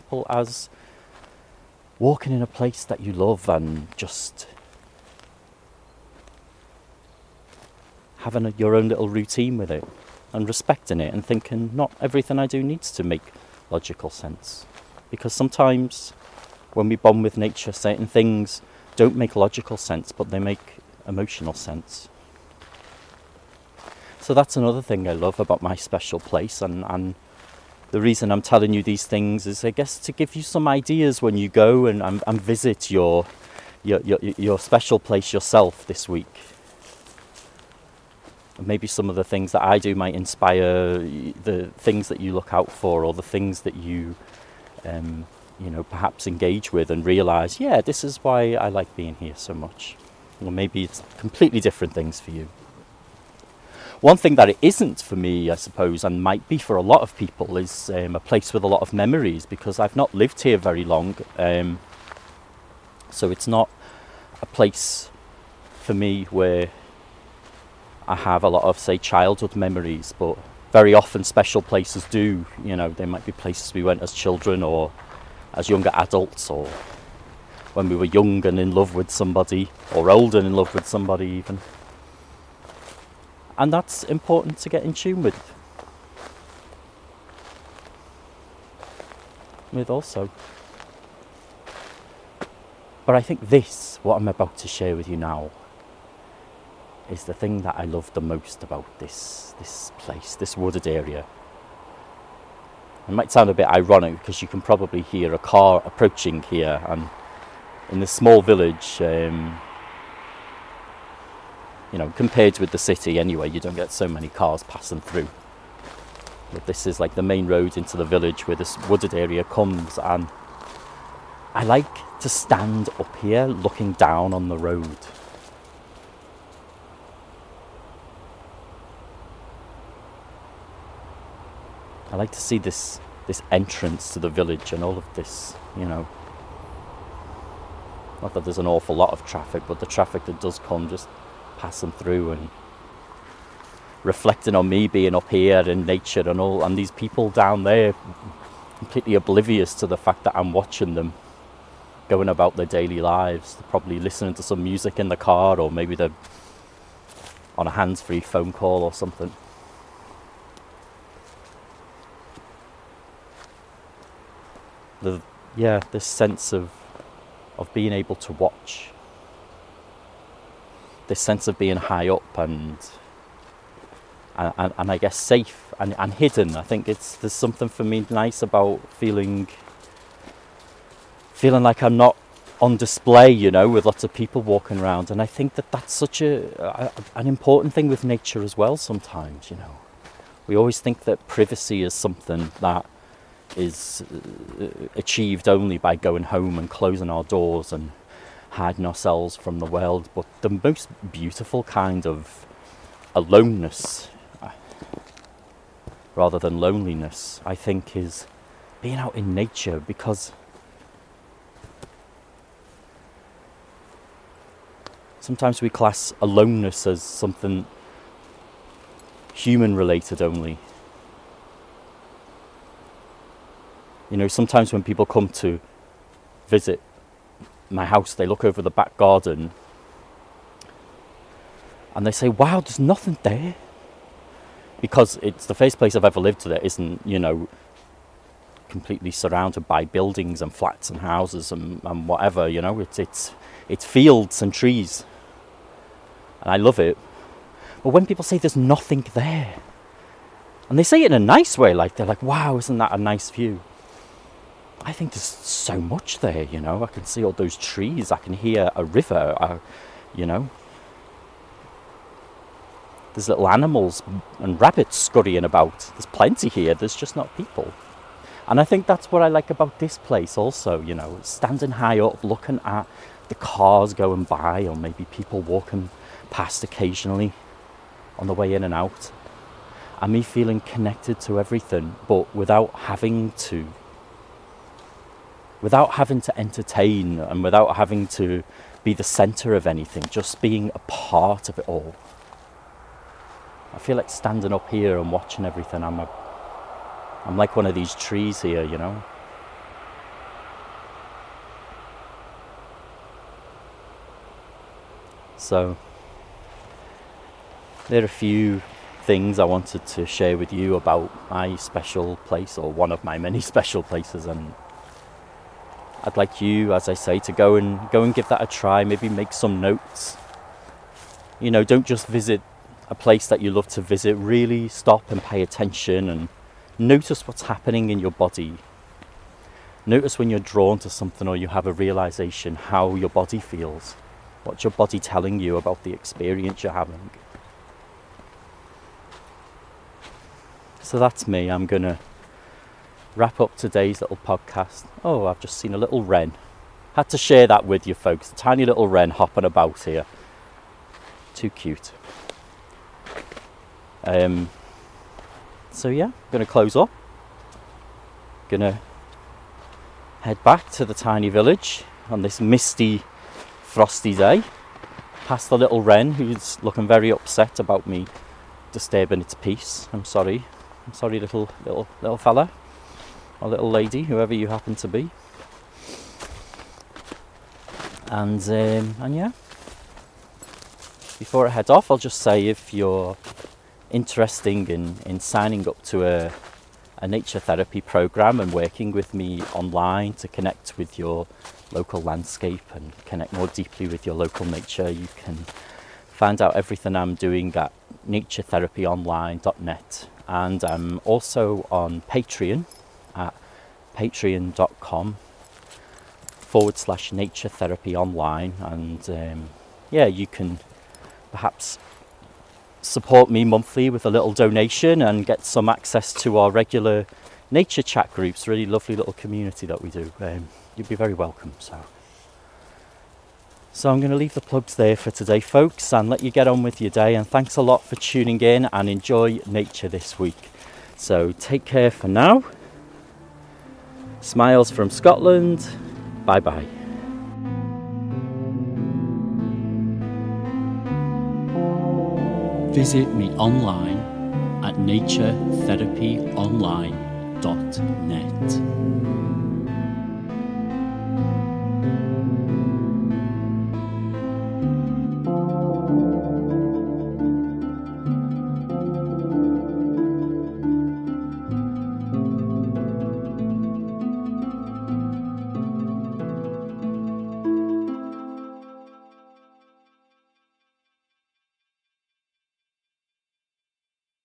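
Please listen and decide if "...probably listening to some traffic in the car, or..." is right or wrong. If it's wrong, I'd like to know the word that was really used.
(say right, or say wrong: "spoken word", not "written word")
wrong: "music", not "traffic".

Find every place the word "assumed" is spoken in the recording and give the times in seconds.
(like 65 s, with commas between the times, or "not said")
not said.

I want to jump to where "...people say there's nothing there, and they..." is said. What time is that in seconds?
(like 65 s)
248 s.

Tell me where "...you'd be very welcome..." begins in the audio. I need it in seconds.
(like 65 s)
420 s.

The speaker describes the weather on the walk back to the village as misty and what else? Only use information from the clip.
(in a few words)
frosty.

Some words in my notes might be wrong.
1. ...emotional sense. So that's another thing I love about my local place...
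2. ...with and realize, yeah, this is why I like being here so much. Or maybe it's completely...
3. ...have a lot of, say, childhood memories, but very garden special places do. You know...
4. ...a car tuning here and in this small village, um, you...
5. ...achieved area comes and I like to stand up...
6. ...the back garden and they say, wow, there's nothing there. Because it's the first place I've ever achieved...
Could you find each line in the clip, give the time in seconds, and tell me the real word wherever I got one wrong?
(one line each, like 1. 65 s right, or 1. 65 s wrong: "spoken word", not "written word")
1. 21 s wrong: "special", not "local"
2. 46 s right
3. 68 s wrong: "often", not "garden"
4. 105 s wrong: "approaching", not "tuning"
5. 118 s wrong: "wooded", not "achieved"
6. 228 s wrong: "lived", not "achieved".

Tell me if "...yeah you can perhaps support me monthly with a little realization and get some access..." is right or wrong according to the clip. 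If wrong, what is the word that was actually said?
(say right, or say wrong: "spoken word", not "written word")
wrong: "donation", not "realization".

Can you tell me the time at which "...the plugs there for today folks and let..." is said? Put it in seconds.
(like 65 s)
424 s.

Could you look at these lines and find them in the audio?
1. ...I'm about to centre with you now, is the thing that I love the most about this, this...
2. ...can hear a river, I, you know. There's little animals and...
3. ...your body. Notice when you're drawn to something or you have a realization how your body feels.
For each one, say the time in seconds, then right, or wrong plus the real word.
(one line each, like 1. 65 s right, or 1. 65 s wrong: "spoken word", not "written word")
1. 94 s wrong: "share", not "centre"
2. 258 s right
3. 328 s right.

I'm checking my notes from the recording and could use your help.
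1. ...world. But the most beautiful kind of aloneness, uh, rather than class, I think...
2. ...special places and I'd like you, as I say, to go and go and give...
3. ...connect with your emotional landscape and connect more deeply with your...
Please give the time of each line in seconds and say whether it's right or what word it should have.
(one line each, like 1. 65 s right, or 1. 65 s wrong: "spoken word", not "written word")
1. 199 s wrong: "loneliness", not "class"
2. 313 s right
3. 390 s wrong: "local", not "emotional".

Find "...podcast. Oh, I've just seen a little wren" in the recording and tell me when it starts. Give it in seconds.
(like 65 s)
344 s.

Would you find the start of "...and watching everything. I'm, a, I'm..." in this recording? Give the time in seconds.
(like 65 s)
294 s.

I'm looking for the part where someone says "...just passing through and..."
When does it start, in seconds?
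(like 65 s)
140 s.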